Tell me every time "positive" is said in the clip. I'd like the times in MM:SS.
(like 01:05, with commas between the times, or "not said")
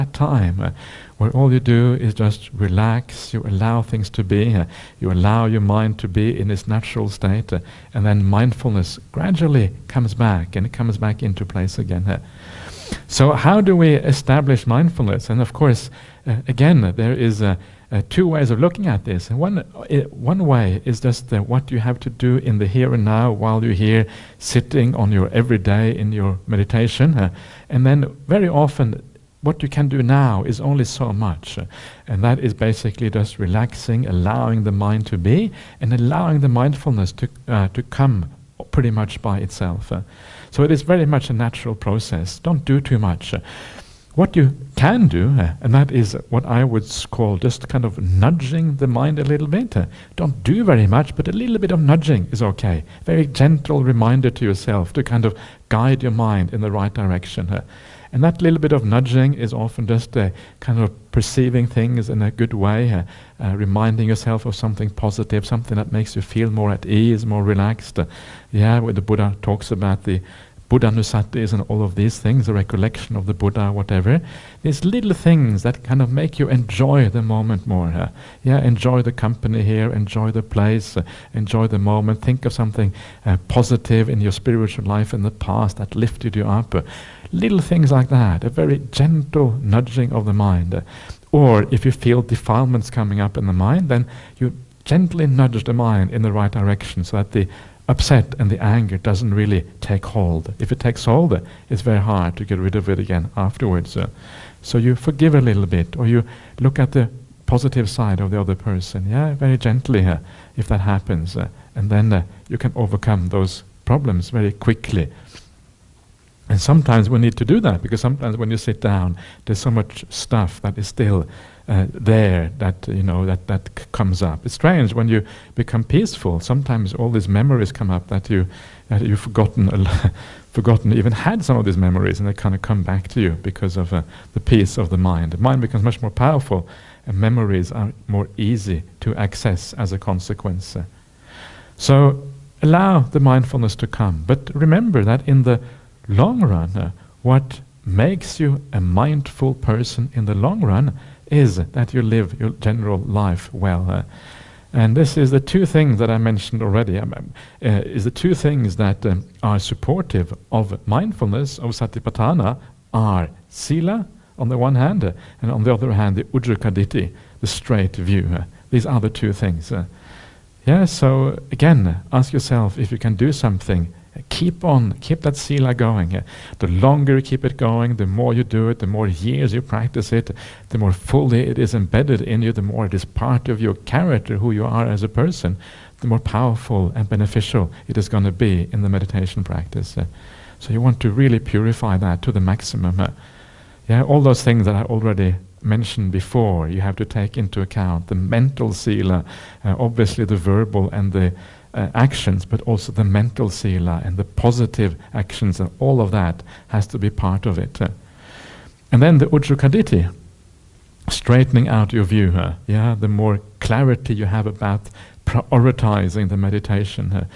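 01:04, 01:23, 01:47, 03:24.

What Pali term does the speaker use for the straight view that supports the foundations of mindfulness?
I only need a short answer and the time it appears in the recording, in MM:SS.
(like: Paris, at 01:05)
ujjakaditi, at 02:46.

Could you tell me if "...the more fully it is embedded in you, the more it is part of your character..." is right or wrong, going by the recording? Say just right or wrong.
right.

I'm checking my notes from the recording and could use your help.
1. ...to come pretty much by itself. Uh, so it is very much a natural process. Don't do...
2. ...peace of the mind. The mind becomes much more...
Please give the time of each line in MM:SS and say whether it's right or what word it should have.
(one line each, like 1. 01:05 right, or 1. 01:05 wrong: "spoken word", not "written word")
1. 00:37 right
2. 02:14 right.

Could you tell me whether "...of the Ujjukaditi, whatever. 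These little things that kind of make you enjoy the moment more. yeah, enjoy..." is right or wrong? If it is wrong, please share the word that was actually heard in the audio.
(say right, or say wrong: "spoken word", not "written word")
wrong: "Buddha", not "Ujjukaditi".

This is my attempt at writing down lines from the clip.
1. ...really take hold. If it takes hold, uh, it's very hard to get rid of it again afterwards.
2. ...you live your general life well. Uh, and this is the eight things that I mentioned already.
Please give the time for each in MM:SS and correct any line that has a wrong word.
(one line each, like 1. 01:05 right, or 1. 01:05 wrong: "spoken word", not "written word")
1. 01:39 right
2. 02:31 wrong: "two", not "eight".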